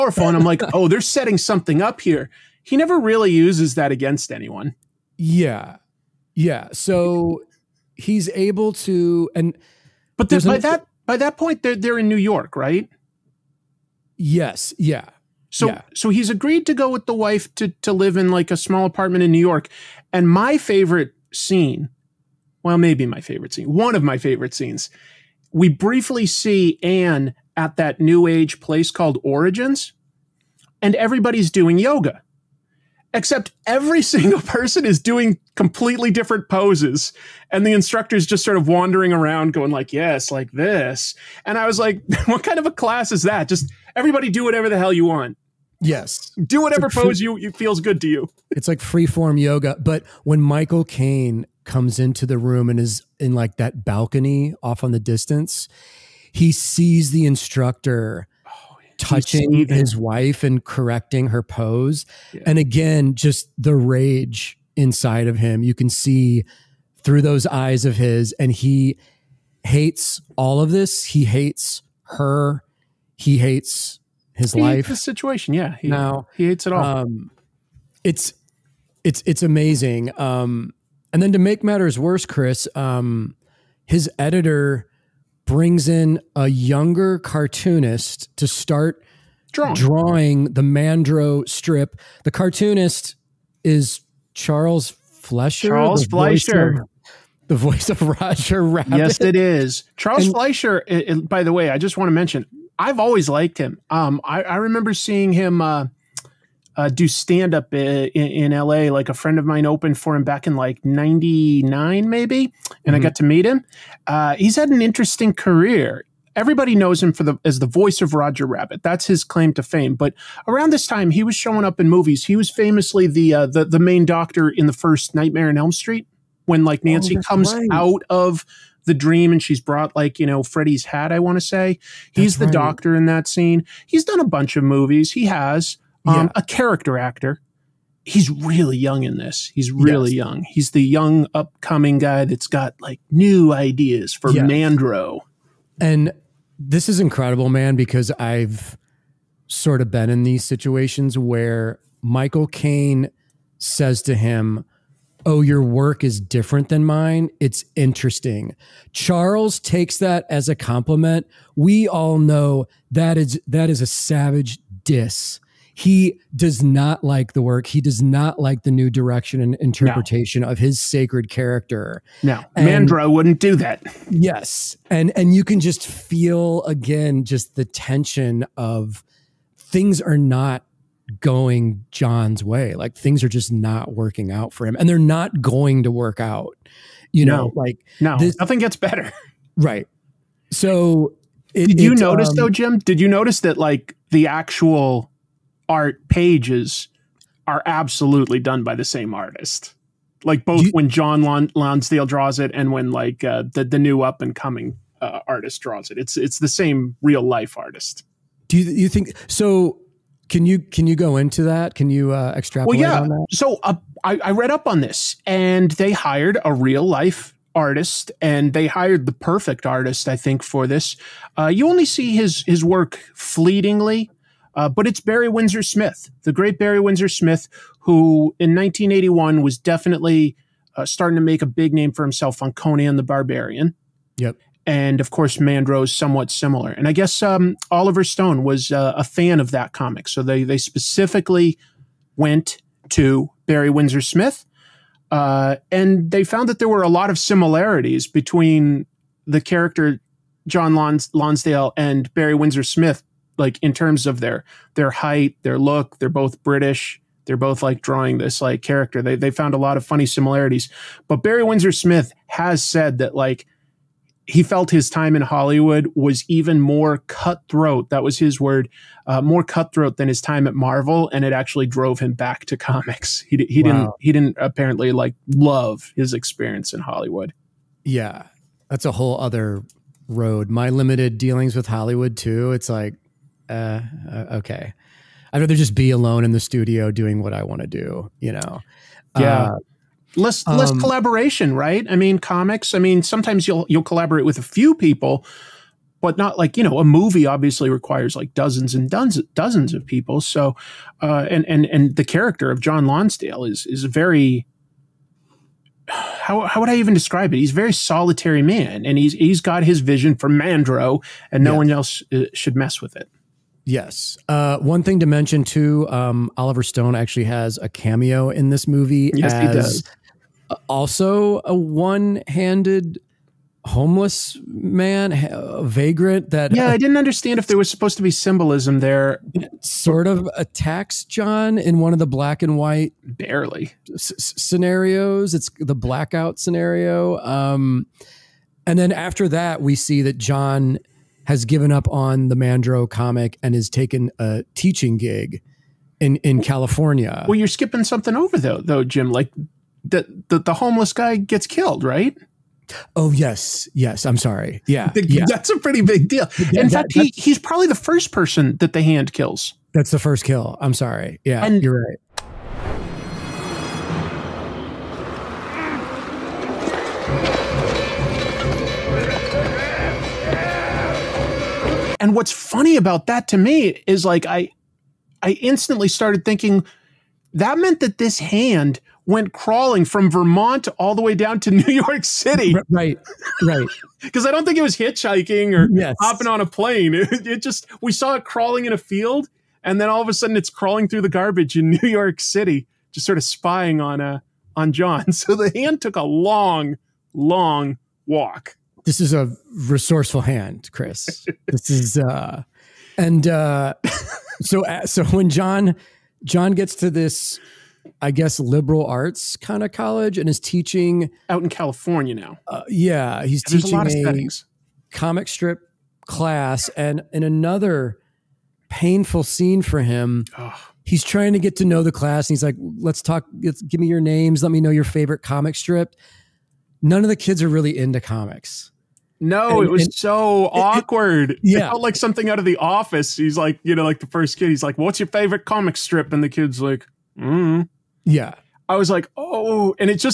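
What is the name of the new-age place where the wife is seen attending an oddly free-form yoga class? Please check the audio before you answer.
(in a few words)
Origins.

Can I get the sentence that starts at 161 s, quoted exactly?
We all know that is that is a savage diss.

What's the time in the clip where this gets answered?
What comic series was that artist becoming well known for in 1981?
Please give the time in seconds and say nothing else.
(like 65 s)
232 s.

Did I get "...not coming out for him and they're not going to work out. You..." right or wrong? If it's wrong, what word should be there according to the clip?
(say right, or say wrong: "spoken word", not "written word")
wrong: "working", not "coming".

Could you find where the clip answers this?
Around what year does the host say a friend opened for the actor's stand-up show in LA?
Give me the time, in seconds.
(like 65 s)
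110 s.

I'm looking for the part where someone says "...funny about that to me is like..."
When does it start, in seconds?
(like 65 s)
372 s.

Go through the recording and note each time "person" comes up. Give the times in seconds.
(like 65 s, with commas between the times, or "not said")
34 s, 358 s.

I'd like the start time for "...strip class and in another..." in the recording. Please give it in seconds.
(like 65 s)
415 s.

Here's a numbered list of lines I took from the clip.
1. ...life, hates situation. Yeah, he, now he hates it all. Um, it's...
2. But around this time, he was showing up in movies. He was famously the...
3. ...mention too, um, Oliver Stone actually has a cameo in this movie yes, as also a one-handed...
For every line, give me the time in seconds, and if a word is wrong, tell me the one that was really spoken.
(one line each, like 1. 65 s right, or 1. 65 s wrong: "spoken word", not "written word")
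1. 74 s right
2. 119 s right
3. 315 s right.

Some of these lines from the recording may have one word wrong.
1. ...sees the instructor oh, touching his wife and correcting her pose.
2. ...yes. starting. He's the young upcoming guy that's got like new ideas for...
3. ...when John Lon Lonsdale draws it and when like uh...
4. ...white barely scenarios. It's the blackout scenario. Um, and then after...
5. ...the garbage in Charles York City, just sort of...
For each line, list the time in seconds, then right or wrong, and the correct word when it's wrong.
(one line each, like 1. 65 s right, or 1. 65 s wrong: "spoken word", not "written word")
1. 56 s right
2. 140 s wrong: "young", not "starting"
3. 200 s right
4. 332 s right
5. 391 s wrong: "New", not "Charles".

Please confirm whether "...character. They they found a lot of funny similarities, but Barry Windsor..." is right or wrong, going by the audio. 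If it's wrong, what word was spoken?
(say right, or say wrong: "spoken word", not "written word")
right.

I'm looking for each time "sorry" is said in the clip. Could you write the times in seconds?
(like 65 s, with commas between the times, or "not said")
354 s, 360 s.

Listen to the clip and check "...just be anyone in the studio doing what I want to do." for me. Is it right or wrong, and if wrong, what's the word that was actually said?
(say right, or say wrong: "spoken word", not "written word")
wrong: "alone", not "anyone".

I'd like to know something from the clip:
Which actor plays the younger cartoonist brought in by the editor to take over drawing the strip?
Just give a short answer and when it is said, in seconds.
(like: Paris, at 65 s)
Charles Fleischer, at 92 s.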